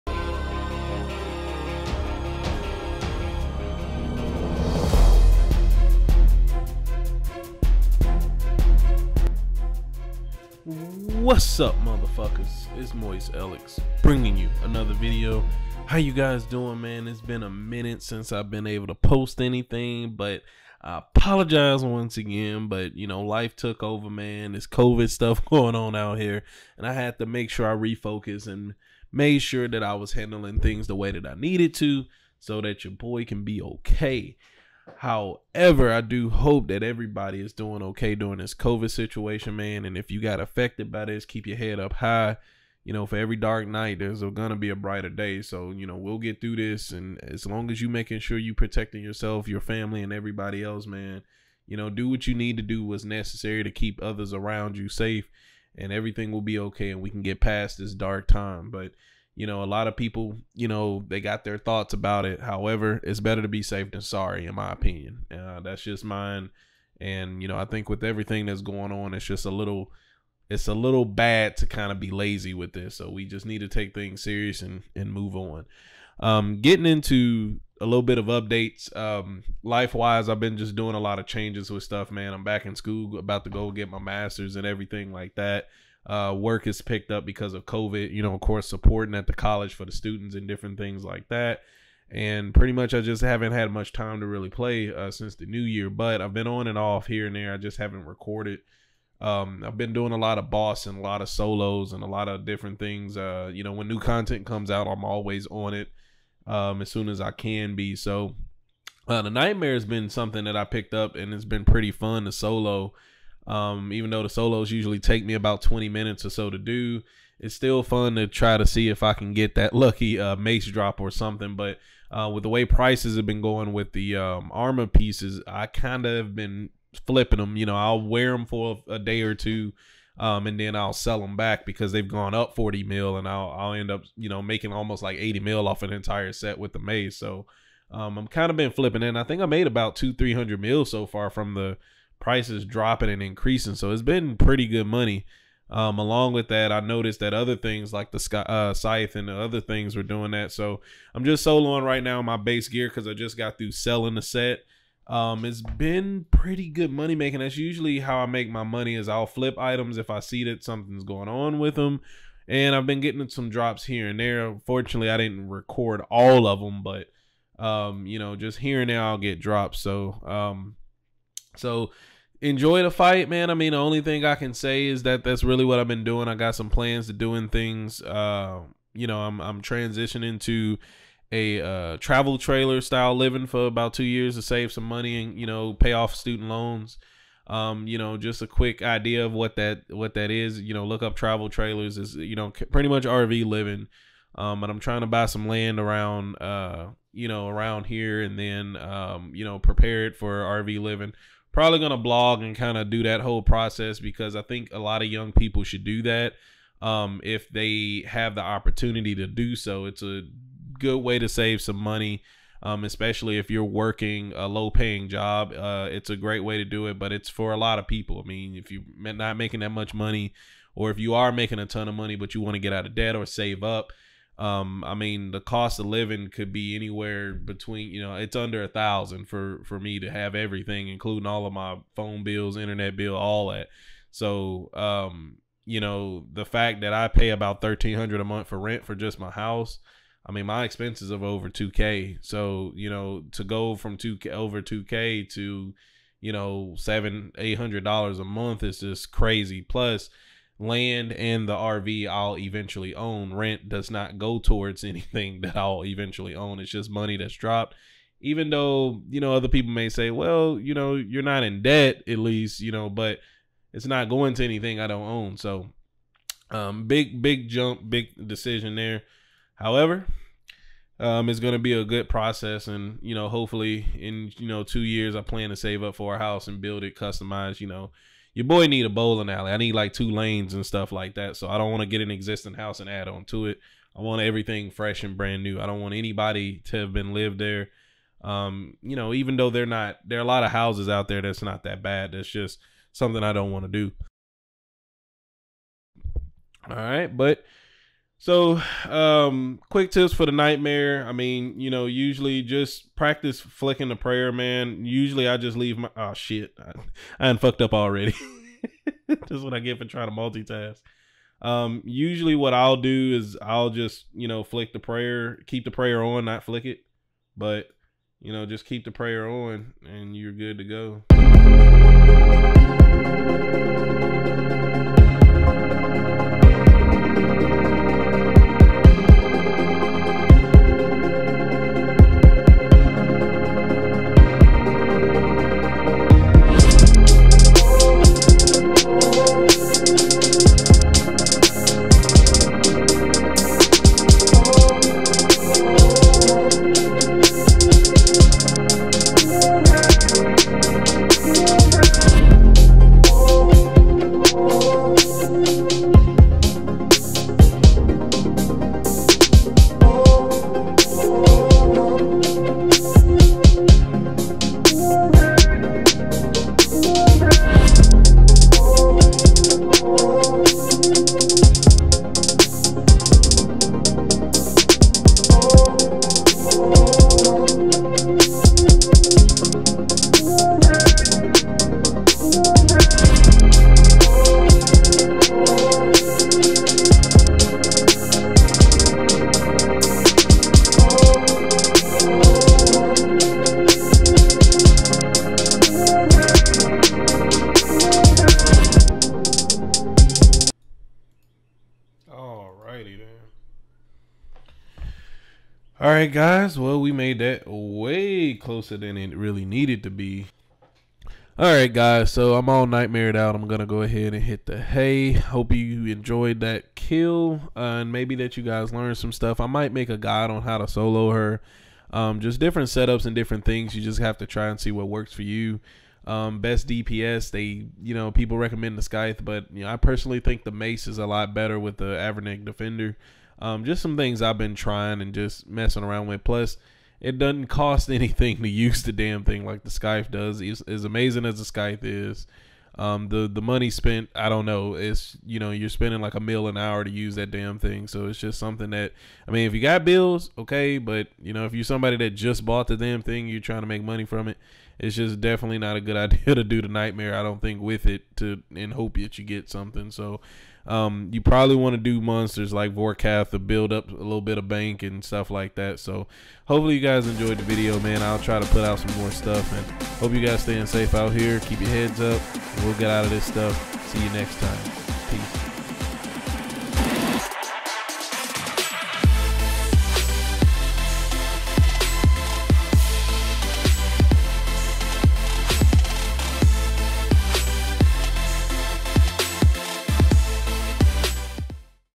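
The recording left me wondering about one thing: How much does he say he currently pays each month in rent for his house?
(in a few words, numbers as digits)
1300.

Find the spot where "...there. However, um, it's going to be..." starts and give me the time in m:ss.
4:28.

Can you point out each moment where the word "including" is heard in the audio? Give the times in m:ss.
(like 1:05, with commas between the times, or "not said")
3:50.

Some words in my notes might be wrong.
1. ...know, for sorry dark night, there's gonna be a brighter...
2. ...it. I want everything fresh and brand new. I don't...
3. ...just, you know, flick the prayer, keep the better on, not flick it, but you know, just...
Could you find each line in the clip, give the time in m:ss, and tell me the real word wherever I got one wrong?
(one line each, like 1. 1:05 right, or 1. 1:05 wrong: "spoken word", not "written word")
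1. 0:42 wrong: "every", not "sorry"
2. 4:43 right
3. 5:13 wrong: "prayer", not "better".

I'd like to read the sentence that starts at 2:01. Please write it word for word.
But uh, with the way prices have been going with the um, armor pieces, I kind of have been flipping them.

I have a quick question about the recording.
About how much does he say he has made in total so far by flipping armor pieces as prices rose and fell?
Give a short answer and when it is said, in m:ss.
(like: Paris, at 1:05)
200-300 mil, at 2:19.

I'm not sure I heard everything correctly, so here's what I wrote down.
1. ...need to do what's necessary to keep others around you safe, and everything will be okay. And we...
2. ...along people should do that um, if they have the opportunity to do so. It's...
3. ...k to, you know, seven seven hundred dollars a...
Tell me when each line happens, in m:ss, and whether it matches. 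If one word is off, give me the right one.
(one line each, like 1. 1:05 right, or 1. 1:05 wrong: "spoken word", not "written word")
1. 0:52 right
2. 3:25 wrong: "young", not "along"
3. 4:04 wrong: "eight", not "seven".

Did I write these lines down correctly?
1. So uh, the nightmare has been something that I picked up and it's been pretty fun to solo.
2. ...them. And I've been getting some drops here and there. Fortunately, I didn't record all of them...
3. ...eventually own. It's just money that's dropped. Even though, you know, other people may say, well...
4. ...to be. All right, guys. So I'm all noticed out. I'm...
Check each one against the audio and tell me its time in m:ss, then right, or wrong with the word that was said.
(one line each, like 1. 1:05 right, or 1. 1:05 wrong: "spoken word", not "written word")
1. 1:47 right
2. 2:41 right
3. 4:15 right
4. 6:49 wrong: "nightmared", not "noticed".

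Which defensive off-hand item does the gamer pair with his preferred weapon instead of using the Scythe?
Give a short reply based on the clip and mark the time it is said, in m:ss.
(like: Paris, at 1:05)
Avernic Defender, at 7:12.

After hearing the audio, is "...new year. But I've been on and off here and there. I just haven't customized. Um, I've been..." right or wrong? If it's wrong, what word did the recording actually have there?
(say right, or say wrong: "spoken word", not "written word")
wrong: "recorded", not "customized".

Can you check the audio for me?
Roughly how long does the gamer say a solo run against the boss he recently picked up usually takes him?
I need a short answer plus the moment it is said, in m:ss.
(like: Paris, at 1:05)
20 minutes, at 1:55.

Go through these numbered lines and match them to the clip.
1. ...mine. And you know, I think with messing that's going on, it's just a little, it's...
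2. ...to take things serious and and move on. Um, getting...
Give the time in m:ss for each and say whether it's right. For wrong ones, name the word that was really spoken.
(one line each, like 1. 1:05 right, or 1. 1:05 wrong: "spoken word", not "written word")
1. 1:06 wrong: "everything", not "messing"
2. 1:13 right.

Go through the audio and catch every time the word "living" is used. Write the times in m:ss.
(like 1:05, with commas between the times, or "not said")
3:03, 3:13, 3:20, 3:45.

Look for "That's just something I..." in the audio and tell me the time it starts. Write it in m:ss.
4:52.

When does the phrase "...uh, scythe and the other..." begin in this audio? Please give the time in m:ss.
2:28.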